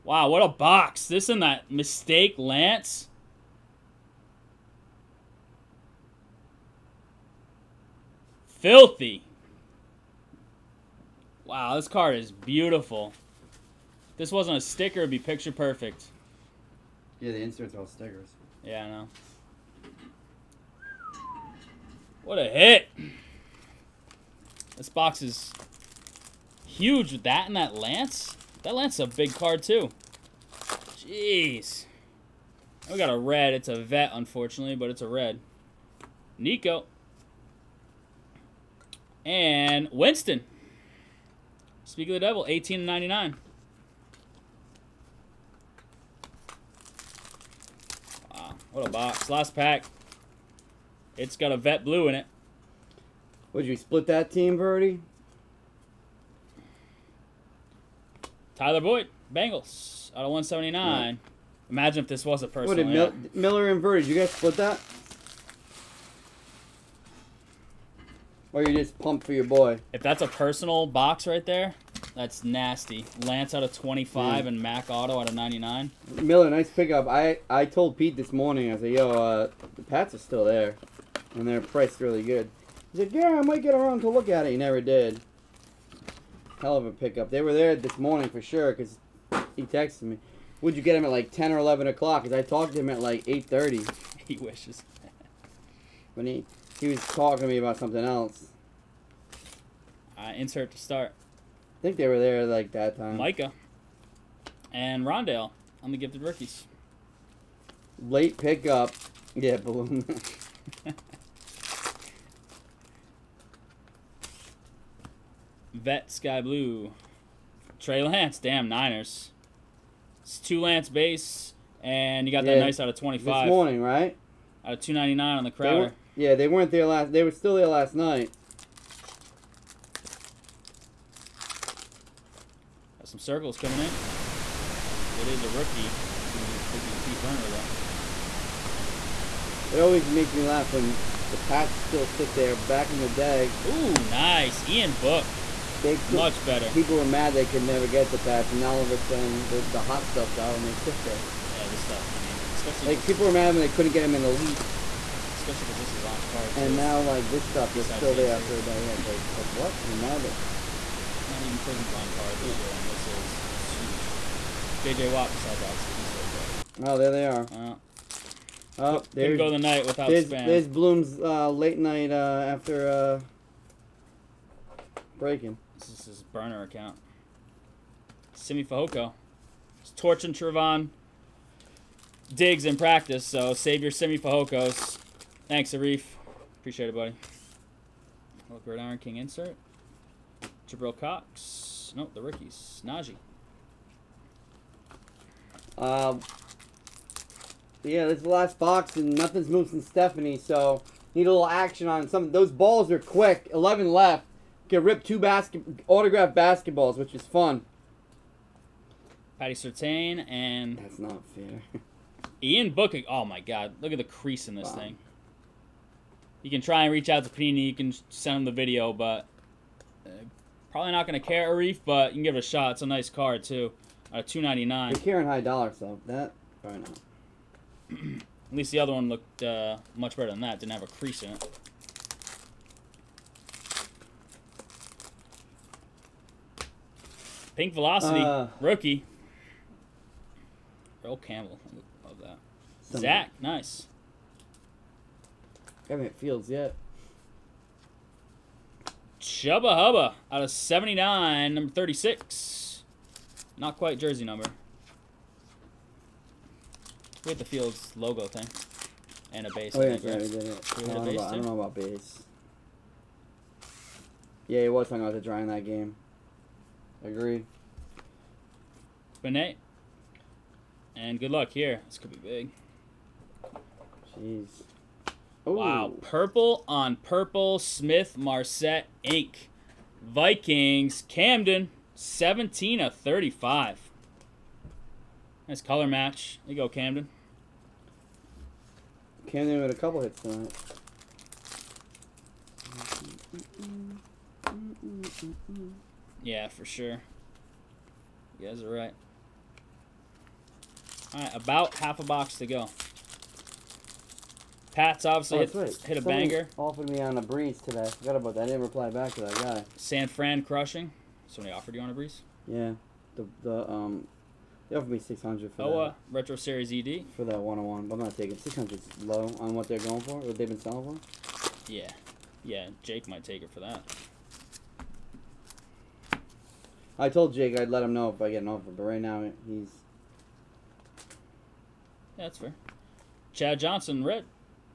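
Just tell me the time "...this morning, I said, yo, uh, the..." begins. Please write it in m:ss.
1:18.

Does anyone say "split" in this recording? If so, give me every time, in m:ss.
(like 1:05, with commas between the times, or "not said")
0:53, 1:04.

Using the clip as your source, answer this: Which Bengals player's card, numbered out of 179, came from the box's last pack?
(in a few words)
Tyler Boyd.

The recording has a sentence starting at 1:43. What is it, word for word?
Micah and Rondale on the gifted rookies.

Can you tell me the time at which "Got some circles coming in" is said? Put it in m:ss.
2:12.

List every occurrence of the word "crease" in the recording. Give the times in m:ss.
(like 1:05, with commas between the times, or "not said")
3:34, 3:50.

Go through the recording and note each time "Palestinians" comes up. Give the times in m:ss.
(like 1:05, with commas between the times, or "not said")
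not said.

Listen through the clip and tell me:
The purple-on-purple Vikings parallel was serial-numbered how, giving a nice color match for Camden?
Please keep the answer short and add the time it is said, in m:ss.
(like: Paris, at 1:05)
17 of 35, at 4:41.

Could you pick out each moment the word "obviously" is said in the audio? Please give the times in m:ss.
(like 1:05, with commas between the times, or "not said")
2:45, 5:05.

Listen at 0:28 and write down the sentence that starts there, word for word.
That Lance is a big card, too.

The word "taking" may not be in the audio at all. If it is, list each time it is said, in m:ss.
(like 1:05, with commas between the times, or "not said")
5:18.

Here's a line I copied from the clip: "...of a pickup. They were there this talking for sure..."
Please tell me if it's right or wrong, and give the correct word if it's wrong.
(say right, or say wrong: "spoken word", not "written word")
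wrong: "morning", not "talking".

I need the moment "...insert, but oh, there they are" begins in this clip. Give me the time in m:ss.
2:45.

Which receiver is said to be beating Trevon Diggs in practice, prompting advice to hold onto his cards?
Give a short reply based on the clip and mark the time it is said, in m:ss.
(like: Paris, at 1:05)
Simi Fehoko, at 2:58.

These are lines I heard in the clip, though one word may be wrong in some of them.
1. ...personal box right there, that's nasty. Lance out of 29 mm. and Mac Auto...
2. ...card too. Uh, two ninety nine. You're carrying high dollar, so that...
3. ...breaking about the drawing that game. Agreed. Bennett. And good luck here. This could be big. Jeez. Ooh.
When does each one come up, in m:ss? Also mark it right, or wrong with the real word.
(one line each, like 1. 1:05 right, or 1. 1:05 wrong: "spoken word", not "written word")
1. 1:10 wrong: "25", not "29"
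2. 3:43 right
3. 4:24 wrong: "talking", not "breaking".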